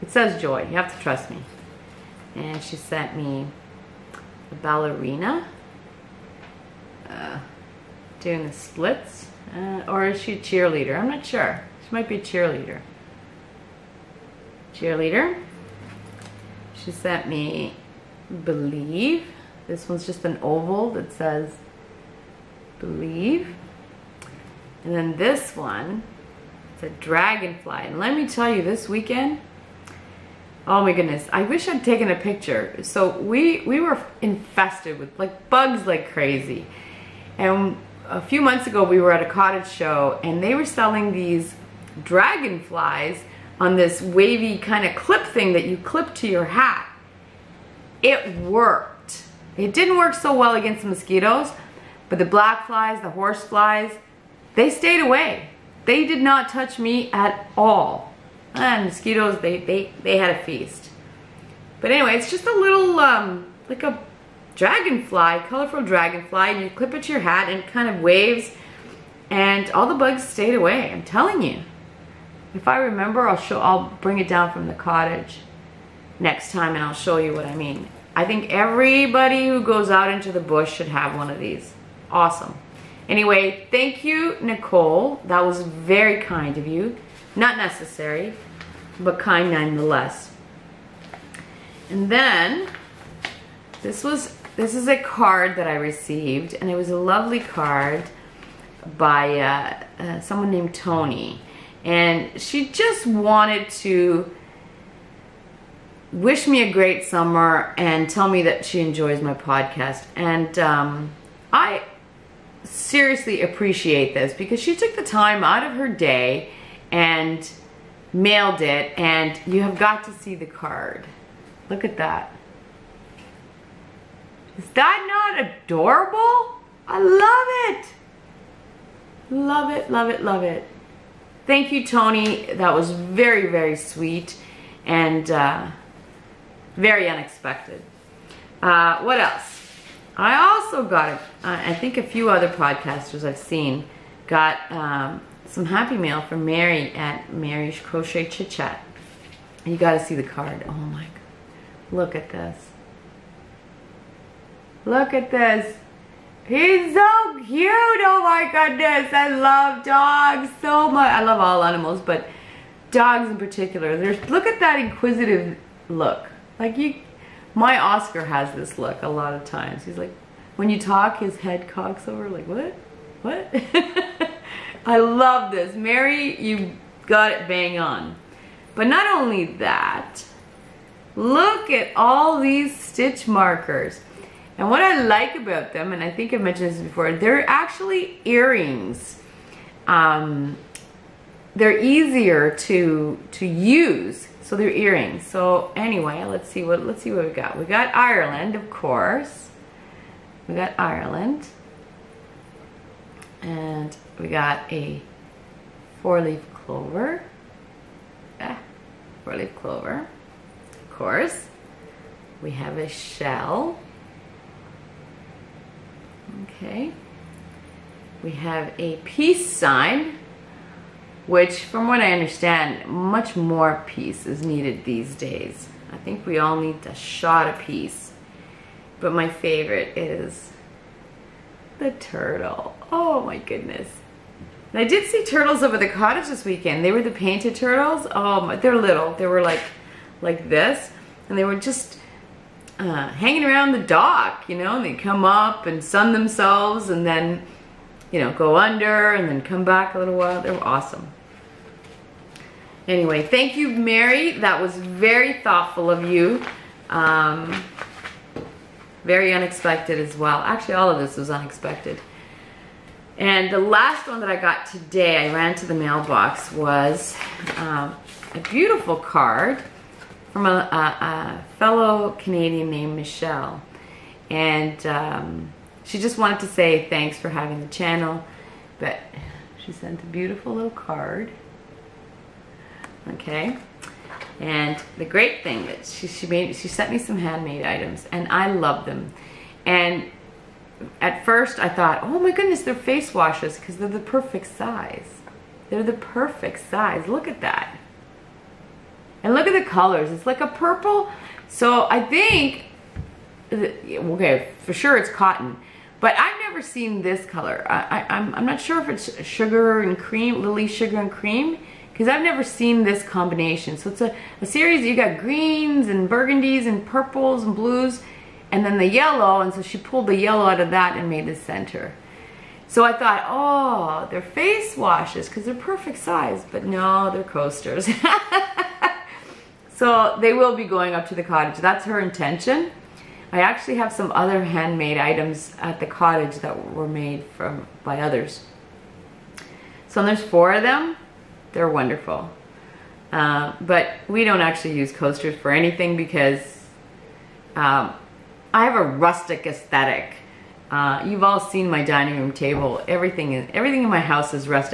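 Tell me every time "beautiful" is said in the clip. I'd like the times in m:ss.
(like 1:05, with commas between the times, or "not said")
4:28, 4:40.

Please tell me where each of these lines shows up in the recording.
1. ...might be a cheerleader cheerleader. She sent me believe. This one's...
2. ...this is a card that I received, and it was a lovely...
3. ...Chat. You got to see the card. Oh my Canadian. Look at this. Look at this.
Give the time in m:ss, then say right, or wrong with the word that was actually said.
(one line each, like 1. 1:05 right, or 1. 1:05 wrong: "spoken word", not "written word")
1. 0:11 right
2. 1:34 right
3. 2:28 wrong: "God", not "Canadian".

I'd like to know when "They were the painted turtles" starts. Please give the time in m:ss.
3:56.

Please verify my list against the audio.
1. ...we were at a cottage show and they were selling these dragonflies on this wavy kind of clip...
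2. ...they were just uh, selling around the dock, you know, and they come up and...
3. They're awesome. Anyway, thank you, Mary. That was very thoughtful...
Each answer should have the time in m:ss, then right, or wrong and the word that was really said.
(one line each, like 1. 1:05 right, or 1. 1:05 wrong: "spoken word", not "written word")
1. 0:38 right
2. 4:01 wrong: "hanging", not "selling"
3. 4:10 right.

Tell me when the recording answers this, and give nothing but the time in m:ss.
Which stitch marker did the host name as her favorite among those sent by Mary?
3:51.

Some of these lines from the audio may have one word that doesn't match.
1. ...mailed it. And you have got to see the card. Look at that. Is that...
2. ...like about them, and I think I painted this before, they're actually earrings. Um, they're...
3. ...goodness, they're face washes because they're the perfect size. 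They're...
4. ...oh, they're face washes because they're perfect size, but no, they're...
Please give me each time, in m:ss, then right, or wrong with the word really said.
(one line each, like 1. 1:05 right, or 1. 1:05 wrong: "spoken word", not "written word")
1. 1:58 right
2. 3:05 wrong: "mentioned", not "painted"
3. 4:52 right
4. 5:23 right.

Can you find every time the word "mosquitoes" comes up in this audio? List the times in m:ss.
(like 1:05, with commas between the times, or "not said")
0:50, 0:58.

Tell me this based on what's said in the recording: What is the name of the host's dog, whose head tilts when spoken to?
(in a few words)
Oscar.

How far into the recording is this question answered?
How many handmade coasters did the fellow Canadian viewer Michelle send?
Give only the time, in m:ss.
5:40.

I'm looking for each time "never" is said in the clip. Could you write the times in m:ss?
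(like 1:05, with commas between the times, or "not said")
5:06, 5:12.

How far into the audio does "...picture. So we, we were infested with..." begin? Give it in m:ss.
0:32.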